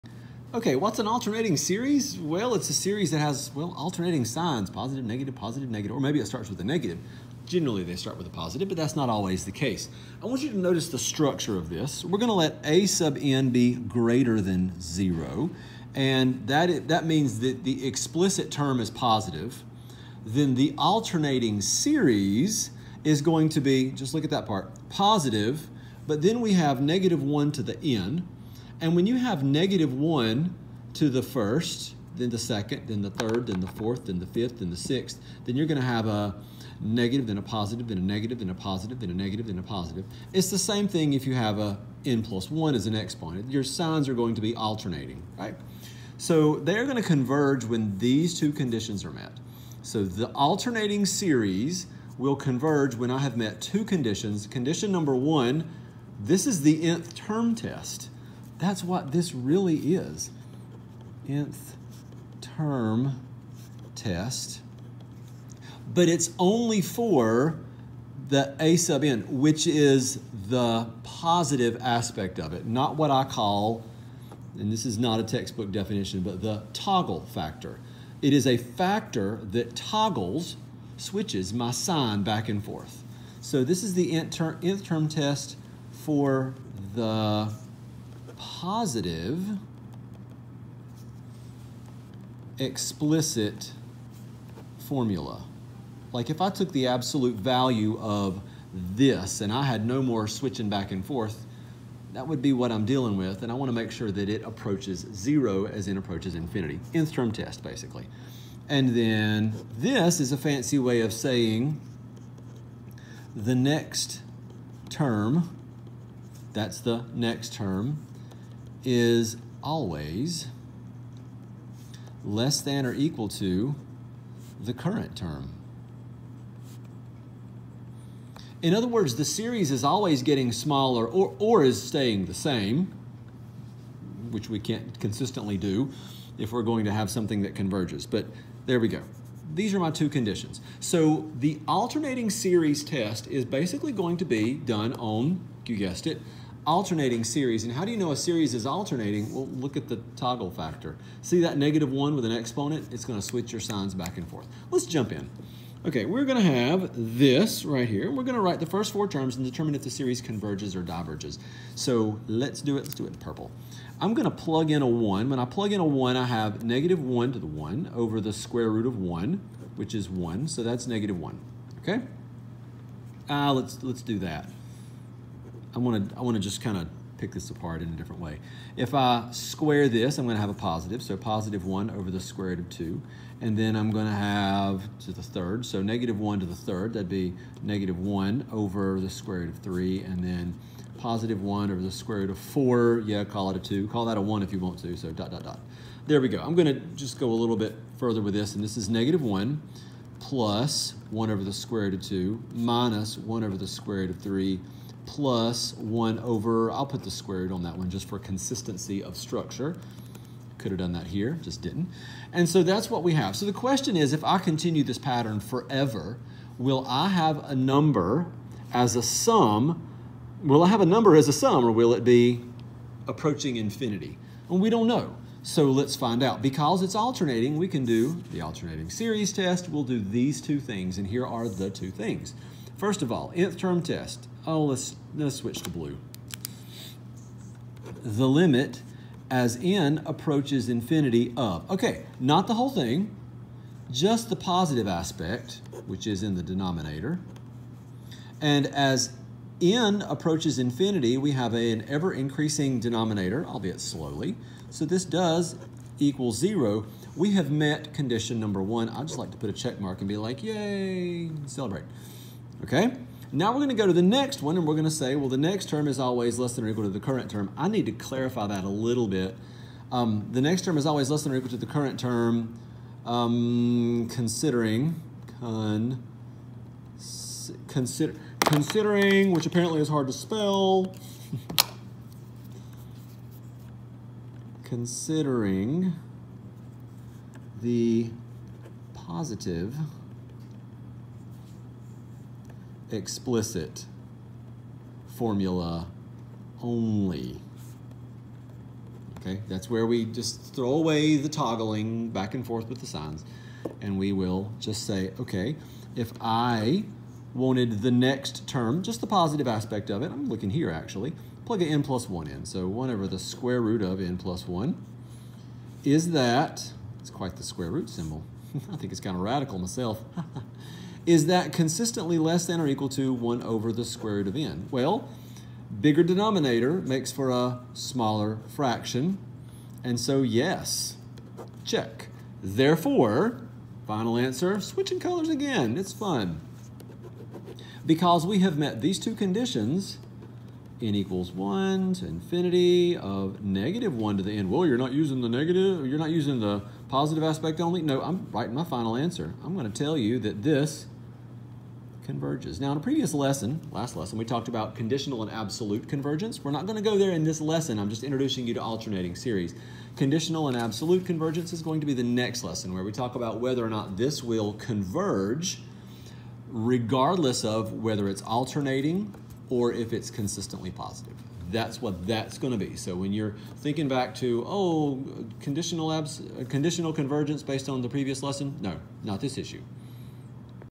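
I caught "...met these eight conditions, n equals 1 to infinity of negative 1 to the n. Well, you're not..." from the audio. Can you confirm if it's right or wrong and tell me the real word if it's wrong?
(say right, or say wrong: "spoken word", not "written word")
wrong: "two", not "eight".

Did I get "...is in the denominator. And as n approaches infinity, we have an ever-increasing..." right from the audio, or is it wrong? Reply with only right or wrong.
right.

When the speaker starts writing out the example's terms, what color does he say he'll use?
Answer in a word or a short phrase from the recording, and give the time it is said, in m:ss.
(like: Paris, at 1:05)
purple, at 2:43.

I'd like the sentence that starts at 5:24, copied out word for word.
Well, bigger denominator makes for a smaller fraction.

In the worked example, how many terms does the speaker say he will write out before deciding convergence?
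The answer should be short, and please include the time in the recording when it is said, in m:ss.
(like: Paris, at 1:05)
4, at 2:38.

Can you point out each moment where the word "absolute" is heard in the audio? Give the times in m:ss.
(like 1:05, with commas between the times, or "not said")
1:36, 5:55, 6:00.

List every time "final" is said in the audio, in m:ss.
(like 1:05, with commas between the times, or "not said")
5:33, 5:48.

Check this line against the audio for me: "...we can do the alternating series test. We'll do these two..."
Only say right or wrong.
right.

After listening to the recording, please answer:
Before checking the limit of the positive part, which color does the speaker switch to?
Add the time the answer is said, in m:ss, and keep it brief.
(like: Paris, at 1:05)
blue, at 3:55.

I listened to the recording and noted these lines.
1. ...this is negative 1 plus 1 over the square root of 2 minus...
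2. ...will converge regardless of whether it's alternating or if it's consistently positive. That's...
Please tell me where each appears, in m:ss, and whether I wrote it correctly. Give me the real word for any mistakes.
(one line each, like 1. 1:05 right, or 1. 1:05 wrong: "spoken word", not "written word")
1. 3:18 right
2. 6:04 right.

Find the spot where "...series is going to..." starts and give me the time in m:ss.
0:21.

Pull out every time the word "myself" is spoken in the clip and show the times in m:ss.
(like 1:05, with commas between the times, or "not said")
5:19.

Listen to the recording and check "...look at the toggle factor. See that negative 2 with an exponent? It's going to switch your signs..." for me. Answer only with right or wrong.
wrong.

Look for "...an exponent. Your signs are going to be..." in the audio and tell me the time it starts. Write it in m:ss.
0:42.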